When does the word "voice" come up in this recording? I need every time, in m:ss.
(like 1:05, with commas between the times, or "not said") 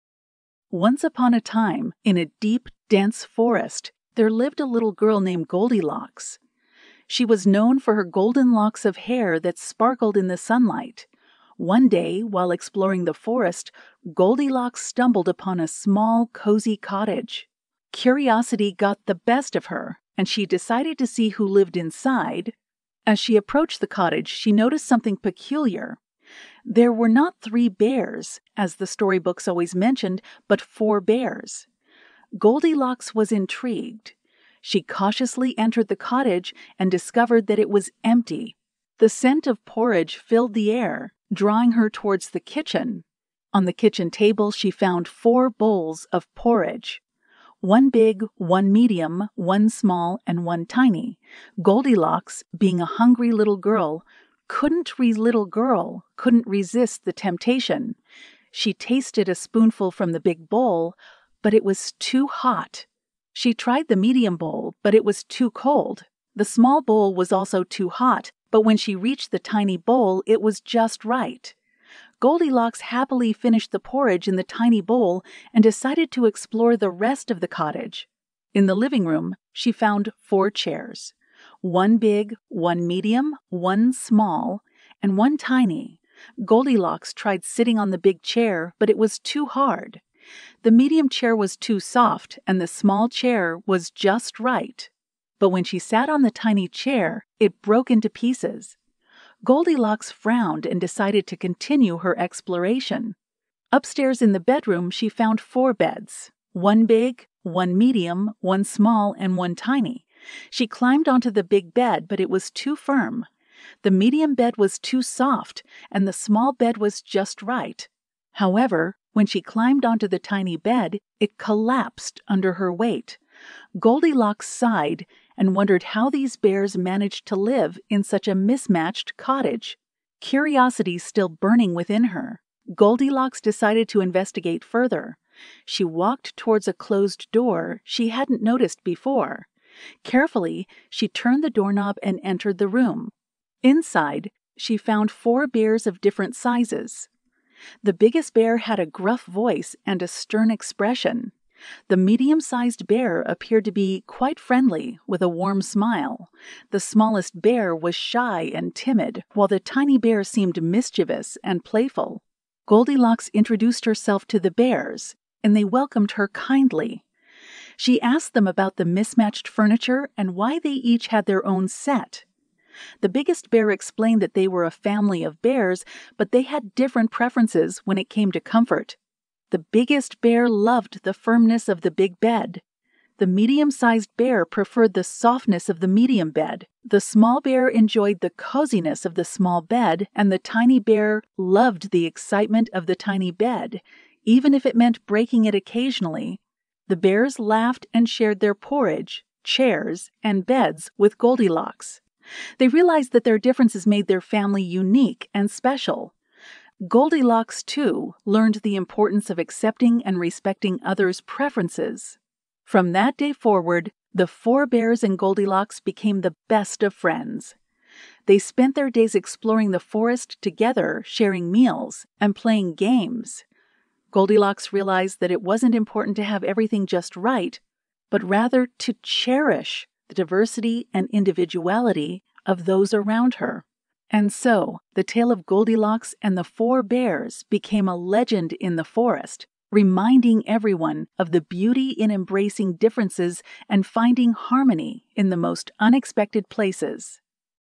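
2:29.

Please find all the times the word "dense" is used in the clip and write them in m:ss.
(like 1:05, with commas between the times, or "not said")
0:02.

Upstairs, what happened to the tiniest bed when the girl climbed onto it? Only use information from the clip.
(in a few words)
It collapsed.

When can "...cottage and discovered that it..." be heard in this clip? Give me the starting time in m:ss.
0:35.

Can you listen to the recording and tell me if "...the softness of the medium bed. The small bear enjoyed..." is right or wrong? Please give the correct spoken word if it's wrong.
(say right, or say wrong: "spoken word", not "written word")
right.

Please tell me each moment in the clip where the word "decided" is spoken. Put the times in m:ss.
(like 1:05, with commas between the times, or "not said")
0:20, 1:15, 1:40, 2:13.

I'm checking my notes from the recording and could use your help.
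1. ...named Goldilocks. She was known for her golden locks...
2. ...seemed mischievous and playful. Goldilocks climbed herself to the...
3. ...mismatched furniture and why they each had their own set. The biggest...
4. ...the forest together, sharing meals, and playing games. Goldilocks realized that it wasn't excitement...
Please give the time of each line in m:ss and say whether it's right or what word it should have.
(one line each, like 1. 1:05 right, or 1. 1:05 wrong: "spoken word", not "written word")
1. 0:05 right
2. 2:40 wrong: "introduced", not "climbed"
3. 2:48 right
4. 3:39 wrong: "important", not "excitement".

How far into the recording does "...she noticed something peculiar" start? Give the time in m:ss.
0:24.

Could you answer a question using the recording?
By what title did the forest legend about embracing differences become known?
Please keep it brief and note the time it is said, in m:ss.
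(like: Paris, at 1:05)
Goldilocks and the Four Bears, at 3:55.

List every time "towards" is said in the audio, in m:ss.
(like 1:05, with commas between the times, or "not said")
0:41, 2:16.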